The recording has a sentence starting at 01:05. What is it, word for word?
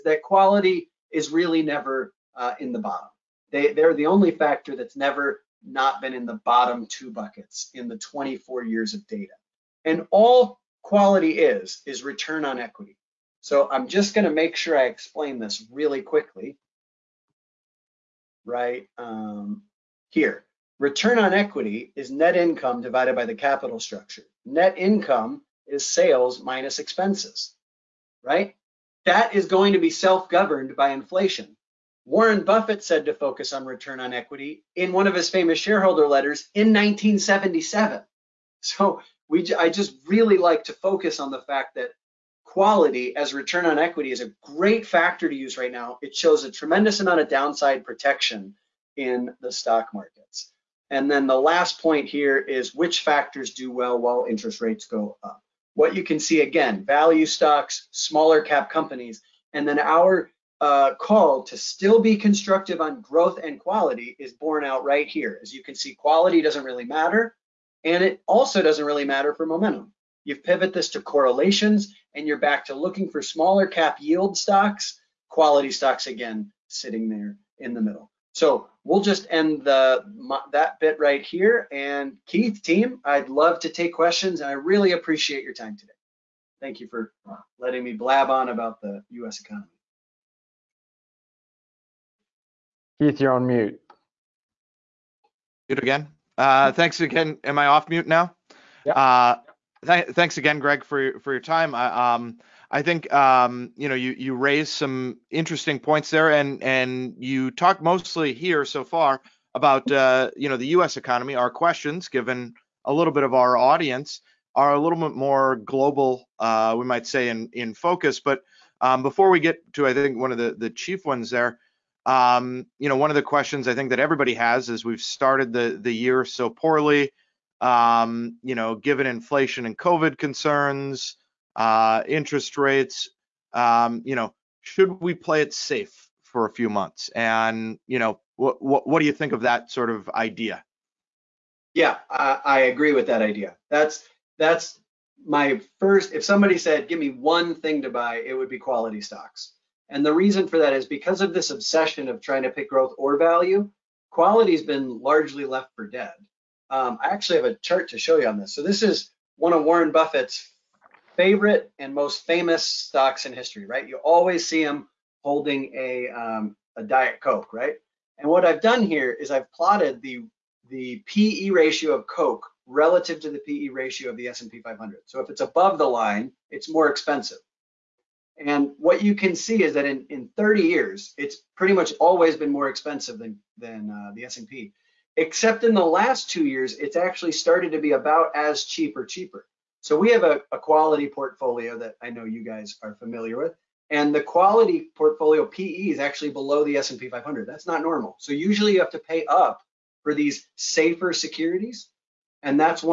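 As you can see, quality doesn't really matter, and it also doesn't really matter for momentum.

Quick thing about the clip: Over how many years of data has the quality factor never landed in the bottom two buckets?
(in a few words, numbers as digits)
24.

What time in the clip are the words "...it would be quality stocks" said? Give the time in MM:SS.
02:28.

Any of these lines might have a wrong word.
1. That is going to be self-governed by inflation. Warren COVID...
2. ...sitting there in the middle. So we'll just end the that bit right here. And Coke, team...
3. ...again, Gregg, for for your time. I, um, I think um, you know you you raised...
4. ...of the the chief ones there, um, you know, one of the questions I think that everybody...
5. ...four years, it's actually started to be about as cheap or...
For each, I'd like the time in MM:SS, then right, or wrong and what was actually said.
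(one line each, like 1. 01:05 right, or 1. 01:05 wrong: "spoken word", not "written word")
1. 00:29 wrong: "Buffett", not "COVID"
2. 01:16 wrong: "Keith", not "Coke"
3. 01:40 right
4. 02:00 right
5. 03:06 wrong: "two", not "four".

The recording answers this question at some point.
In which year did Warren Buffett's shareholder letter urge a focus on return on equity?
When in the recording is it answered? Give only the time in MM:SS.
00:36.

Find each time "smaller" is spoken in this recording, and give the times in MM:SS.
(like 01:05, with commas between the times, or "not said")
00:57, 01:13.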